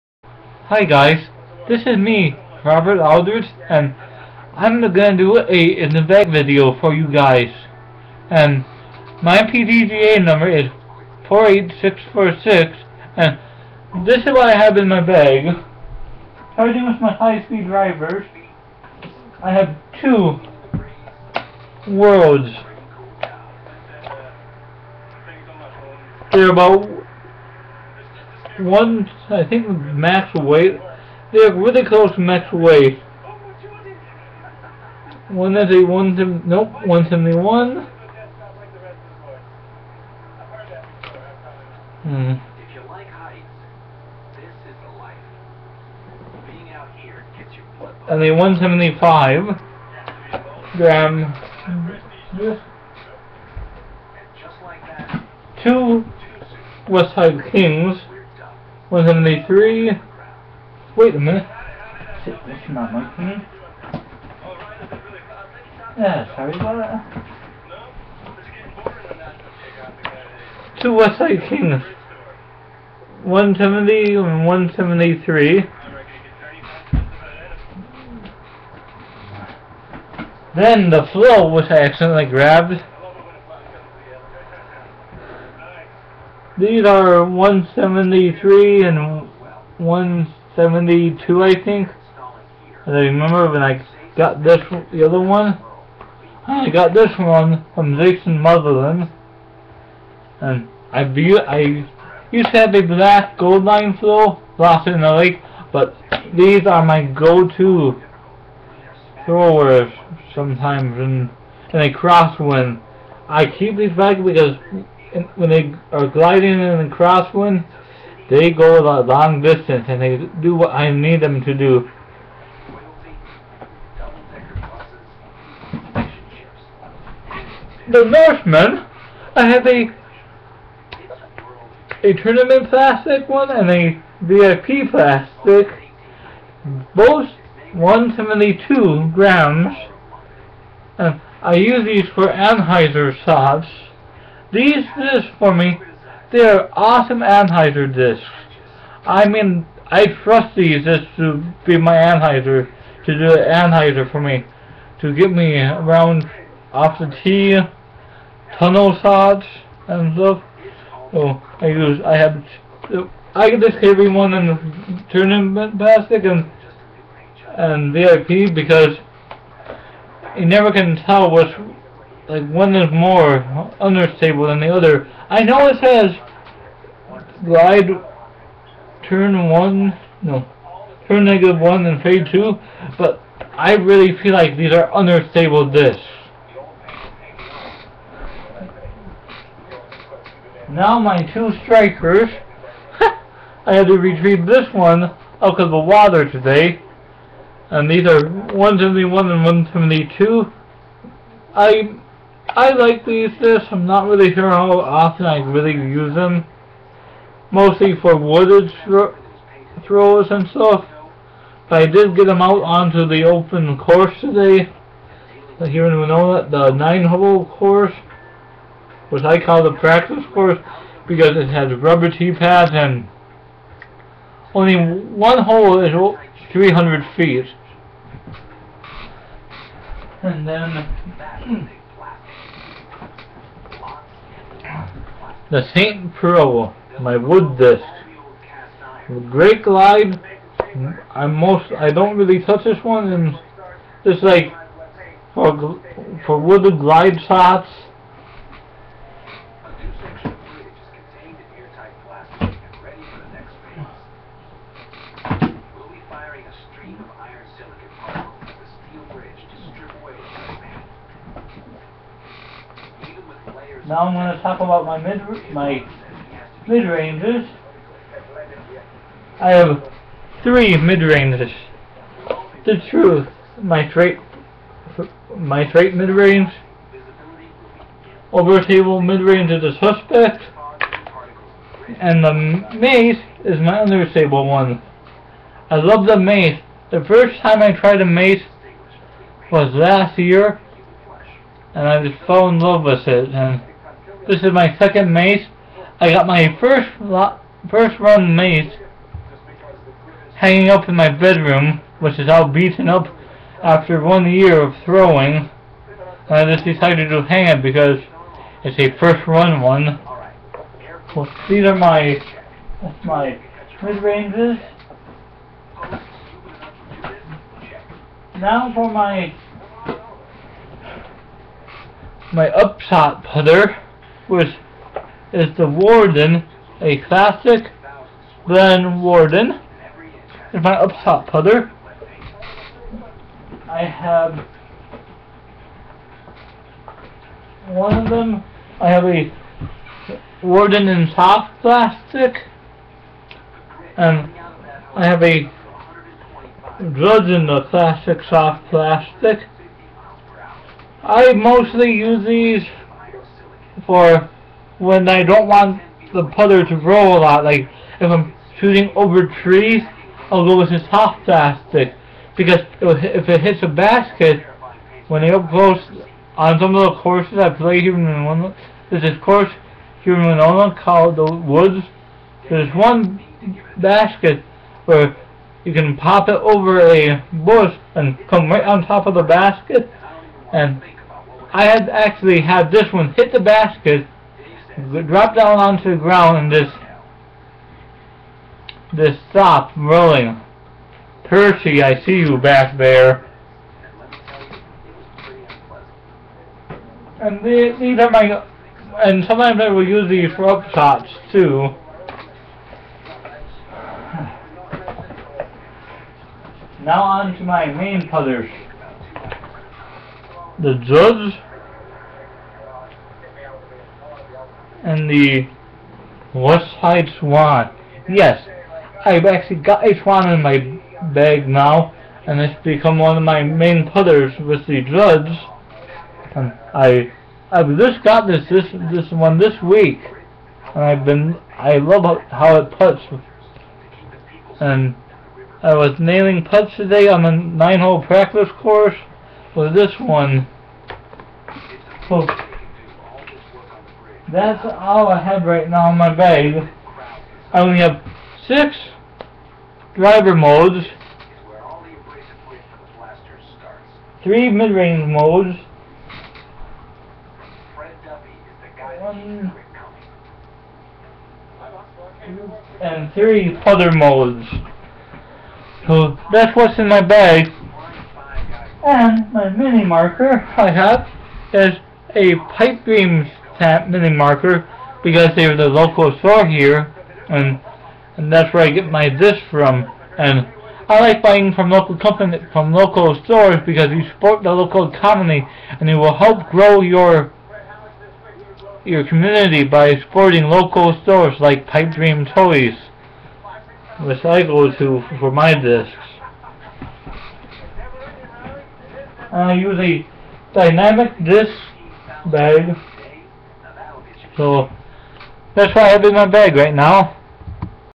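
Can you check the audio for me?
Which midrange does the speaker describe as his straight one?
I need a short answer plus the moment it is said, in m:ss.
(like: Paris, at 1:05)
The Truth, at 4:32.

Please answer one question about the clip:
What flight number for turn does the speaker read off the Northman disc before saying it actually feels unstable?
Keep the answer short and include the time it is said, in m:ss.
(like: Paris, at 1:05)
-1, at 3:01.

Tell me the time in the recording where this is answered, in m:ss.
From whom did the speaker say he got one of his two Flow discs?
1:37.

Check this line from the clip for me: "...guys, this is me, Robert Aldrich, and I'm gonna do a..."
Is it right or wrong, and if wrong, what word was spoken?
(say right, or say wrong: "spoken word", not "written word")
right.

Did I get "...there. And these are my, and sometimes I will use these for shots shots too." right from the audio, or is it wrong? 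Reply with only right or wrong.
wrong.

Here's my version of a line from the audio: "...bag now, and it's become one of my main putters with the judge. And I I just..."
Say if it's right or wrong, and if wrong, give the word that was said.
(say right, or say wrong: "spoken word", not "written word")
right.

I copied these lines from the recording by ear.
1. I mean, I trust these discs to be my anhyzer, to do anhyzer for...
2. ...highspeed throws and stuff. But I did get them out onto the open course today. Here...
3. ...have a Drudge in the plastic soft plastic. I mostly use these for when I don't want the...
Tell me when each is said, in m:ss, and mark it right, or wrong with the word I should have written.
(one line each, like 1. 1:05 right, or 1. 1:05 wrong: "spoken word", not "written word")
1. 2:29 right
2. 3:28 wrong: "wooded", not "highspeed"
3. 5:45 right.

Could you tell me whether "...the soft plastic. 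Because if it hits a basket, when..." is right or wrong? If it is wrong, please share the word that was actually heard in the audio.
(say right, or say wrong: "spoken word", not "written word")
right.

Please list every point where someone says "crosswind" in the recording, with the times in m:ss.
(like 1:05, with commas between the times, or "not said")
1:51, 1:56.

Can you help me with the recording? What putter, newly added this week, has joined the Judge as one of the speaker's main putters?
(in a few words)
West Side Swan.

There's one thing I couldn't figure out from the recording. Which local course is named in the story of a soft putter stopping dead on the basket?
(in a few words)
The Woods.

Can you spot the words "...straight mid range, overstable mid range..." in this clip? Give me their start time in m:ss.
4:35.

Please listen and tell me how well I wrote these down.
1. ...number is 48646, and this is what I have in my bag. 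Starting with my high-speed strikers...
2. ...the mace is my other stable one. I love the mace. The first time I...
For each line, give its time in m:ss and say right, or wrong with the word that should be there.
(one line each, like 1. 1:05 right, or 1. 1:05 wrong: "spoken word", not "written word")
1. 0:10 wrong: "drivers", not "strikers"
2. 4:42 right.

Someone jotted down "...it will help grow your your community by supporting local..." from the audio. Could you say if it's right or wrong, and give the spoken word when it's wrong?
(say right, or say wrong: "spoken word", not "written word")
right.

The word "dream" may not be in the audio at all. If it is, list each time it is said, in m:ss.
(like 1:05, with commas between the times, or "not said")
7:52, 8:11.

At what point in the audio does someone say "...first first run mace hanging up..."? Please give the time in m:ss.
4:56.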